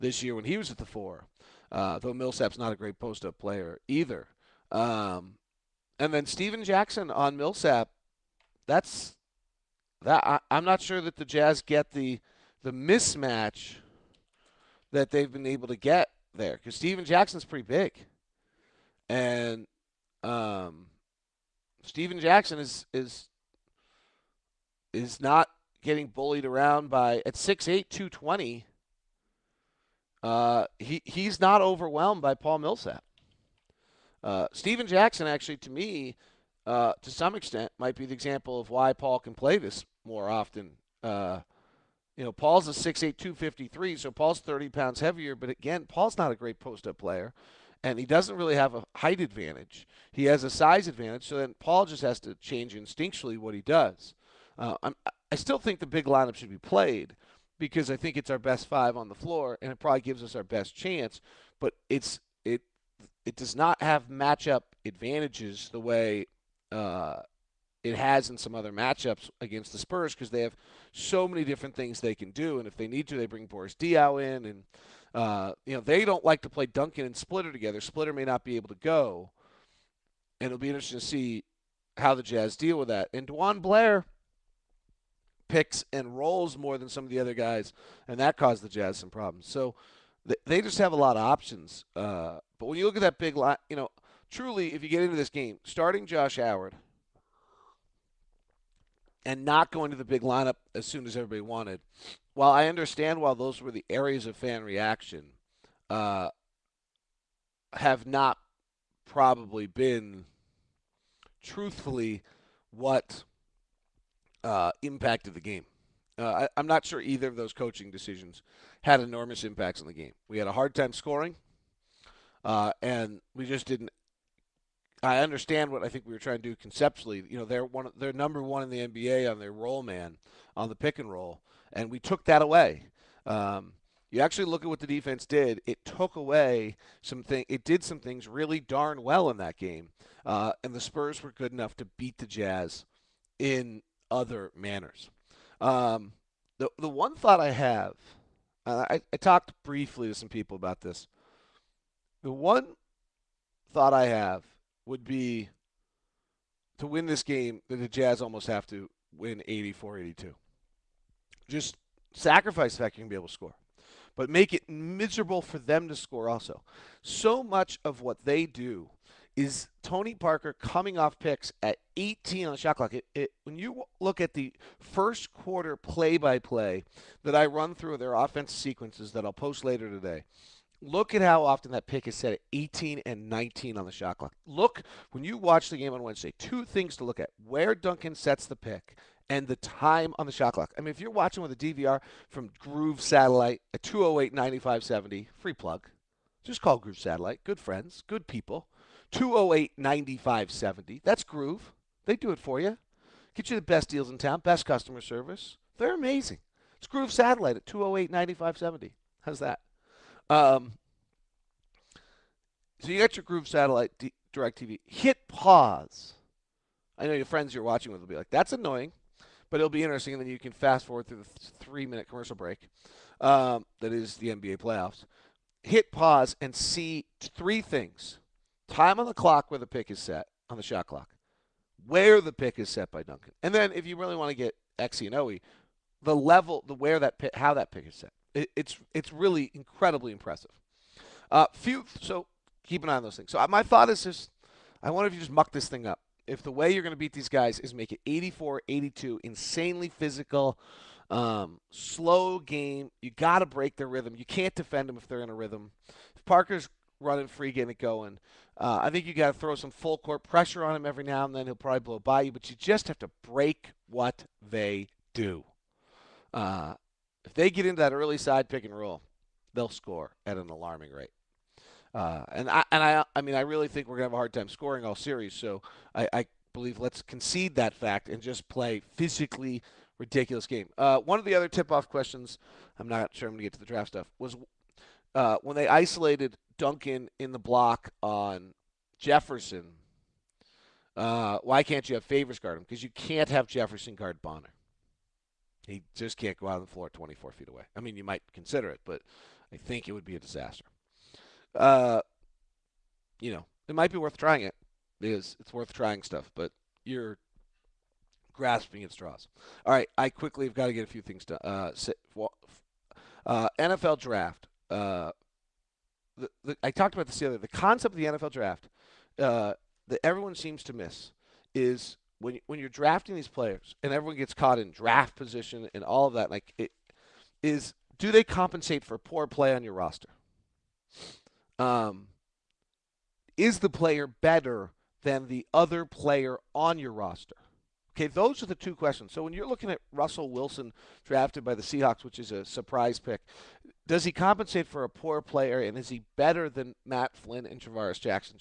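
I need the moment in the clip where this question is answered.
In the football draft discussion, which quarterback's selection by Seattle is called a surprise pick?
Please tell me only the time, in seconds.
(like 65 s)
339 s.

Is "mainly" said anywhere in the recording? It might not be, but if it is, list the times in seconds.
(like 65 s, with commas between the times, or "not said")
not said.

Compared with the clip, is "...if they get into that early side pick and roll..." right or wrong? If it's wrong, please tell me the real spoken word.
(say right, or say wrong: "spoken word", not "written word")
right.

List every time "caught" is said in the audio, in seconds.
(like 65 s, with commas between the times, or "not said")
324 s.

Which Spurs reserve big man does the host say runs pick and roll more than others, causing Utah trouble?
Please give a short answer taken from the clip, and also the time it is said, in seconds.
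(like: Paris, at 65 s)
DeJuan Blair, at 83 s.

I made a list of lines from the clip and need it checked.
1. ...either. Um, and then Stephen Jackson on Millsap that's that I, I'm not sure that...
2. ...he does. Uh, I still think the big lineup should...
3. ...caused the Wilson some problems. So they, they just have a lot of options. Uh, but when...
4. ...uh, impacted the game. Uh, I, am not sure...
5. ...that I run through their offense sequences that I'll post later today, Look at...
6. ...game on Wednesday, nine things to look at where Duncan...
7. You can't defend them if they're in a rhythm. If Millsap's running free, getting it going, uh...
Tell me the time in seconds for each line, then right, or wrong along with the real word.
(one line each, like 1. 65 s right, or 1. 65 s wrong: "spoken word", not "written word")
1. 3 s right
2. 53 s right
3. 88 s wrong: "Jazz", not "Wilson"
4. 114 s right
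5. 177 s right
6. 185 s wrong: "two", not "nine"
7. 254 s wrong: "Parker", not "Millsap".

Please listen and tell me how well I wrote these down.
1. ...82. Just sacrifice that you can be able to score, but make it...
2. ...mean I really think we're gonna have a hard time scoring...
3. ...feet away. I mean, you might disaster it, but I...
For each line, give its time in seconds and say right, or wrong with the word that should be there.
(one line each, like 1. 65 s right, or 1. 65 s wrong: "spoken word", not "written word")
1. 159 s right
2. 273 s right
3. 297 s wrong: "consider", not "disaster".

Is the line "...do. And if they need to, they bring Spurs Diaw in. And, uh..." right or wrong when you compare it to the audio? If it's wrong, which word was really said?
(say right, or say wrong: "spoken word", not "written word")
wrong: "Boris", not "Spurs".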